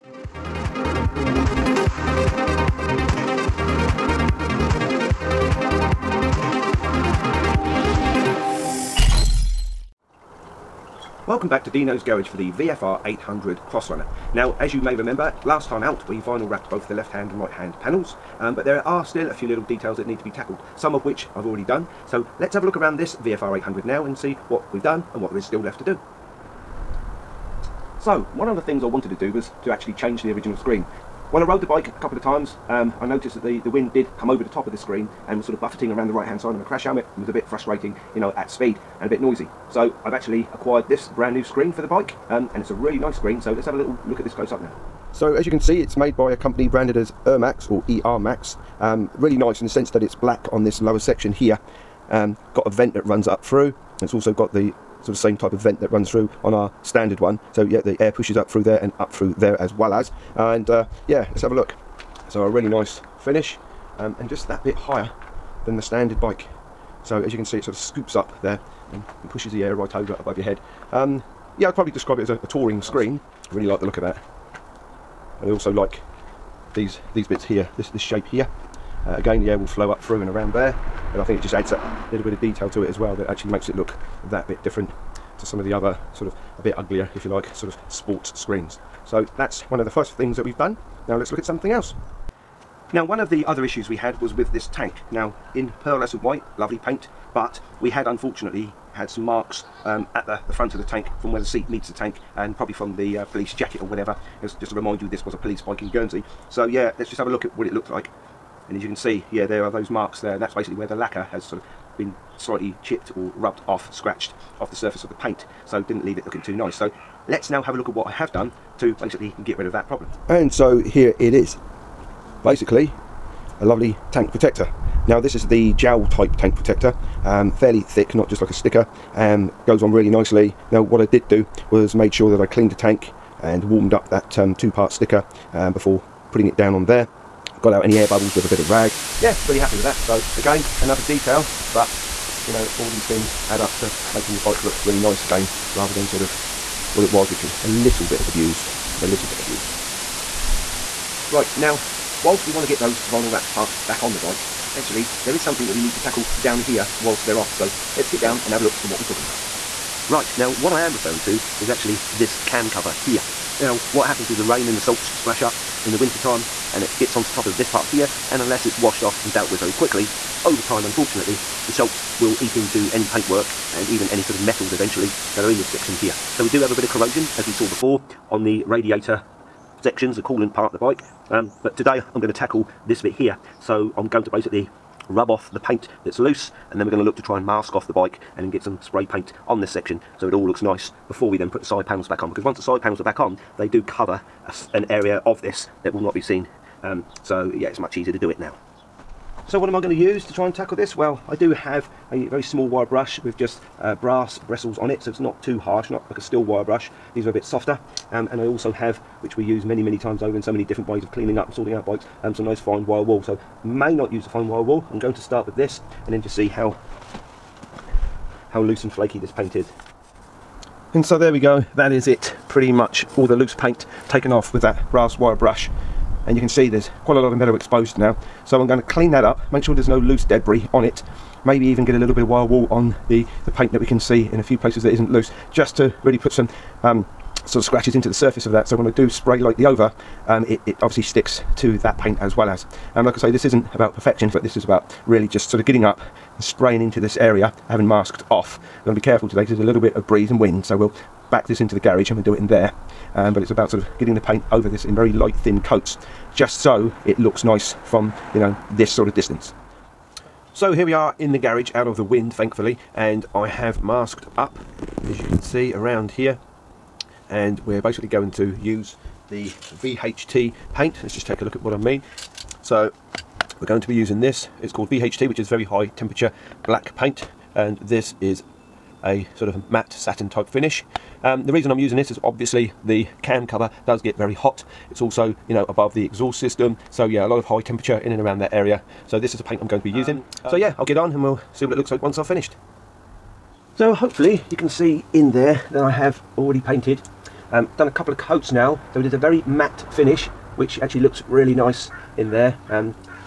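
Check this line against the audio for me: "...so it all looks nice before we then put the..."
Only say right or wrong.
right.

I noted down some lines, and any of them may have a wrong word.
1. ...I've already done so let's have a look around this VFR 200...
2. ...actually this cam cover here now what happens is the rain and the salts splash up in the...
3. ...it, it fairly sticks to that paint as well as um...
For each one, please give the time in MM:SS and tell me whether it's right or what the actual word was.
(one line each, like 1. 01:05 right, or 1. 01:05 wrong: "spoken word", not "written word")
1. 00:21 wrong: "800", not "200"
2. 02:41 right
3. 04:00 wrong: "obviously", not "fairly".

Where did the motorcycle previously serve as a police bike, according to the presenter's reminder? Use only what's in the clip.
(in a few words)
Guernsey.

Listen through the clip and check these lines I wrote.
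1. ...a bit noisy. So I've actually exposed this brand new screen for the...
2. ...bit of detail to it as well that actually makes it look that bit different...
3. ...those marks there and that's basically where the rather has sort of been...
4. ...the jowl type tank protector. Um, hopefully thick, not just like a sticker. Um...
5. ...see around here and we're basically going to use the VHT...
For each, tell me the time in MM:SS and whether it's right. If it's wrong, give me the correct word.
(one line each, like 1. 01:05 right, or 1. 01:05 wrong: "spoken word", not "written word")
1. 00:39 wrong: "acquired", not "exposed"
2. 01:22 right
3. 01:49 wrong: "lacquer", not "rather"
4. 02:05 wrong: "fairly", not "hopefully"
5. 04:25 right.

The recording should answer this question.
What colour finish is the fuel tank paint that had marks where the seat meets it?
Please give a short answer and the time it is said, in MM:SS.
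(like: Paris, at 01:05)
Pearlescent white, at 01:35.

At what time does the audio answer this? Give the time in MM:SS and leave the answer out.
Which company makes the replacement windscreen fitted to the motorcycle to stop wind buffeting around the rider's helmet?
00:47.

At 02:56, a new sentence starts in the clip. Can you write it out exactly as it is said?
So we do have a bit of corrosion as we saw before on the radiator sections, the coolant part of the bike.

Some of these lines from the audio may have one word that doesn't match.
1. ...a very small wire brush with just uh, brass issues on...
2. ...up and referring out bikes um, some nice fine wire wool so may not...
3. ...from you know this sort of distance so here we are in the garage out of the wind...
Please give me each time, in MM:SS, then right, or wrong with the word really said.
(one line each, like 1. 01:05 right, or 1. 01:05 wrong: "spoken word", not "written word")
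1. 03:22 wrong: "bristles", not "issues"
2. 03:31 wrong: "sorting", not "referring"
3. 04:17 right.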